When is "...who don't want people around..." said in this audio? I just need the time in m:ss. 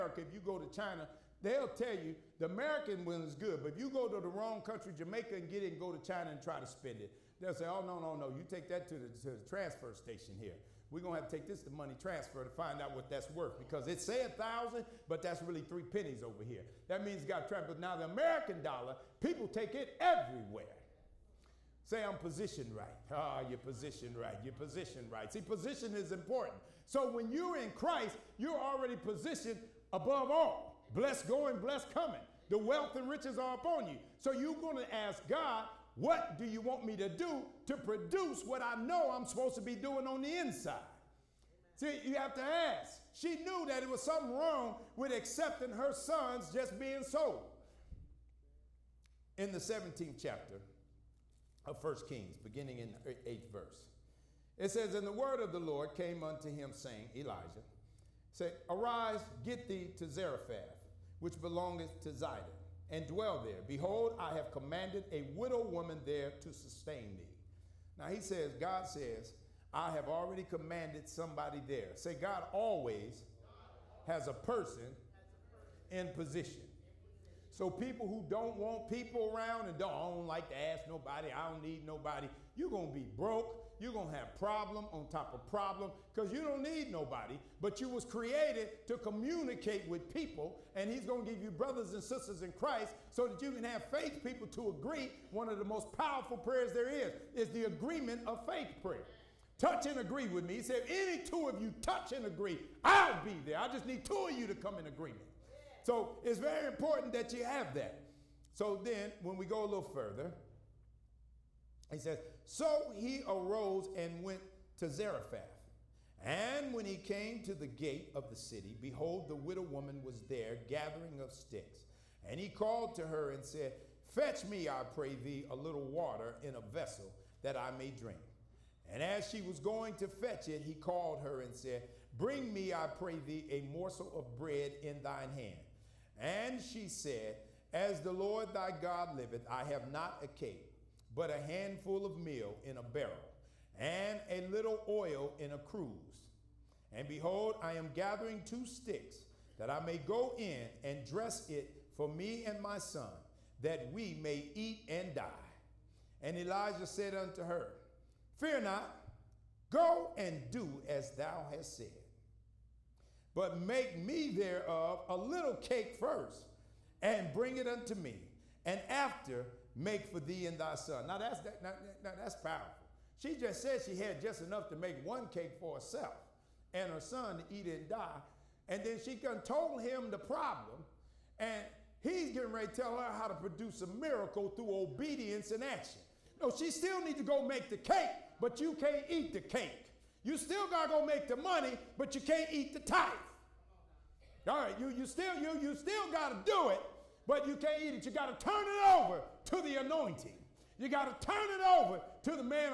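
1:18.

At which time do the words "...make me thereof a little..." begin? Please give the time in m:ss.
2:43.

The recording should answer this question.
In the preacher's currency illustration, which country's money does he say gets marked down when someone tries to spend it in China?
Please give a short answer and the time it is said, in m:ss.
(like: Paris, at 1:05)
Jamaica, at 0:04.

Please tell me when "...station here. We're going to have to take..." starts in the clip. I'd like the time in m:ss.
0:09.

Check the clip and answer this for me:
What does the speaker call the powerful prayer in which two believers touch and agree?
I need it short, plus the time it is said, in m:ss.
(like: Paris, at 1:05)
agreement of faith prayer, at 1:37.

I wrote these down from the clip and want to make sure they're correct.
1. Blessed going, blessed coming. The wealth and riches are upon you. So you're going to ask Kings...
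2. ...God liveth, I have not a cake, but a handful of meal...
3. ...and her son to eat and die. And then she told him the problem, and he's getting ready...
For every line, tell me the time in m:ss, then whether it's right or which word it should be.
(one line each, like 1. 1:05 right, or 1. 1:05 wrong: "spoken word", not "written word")
1. 0:30 wrong: "God", not "Kings"
2. 2:18 right
3. 2:56 right.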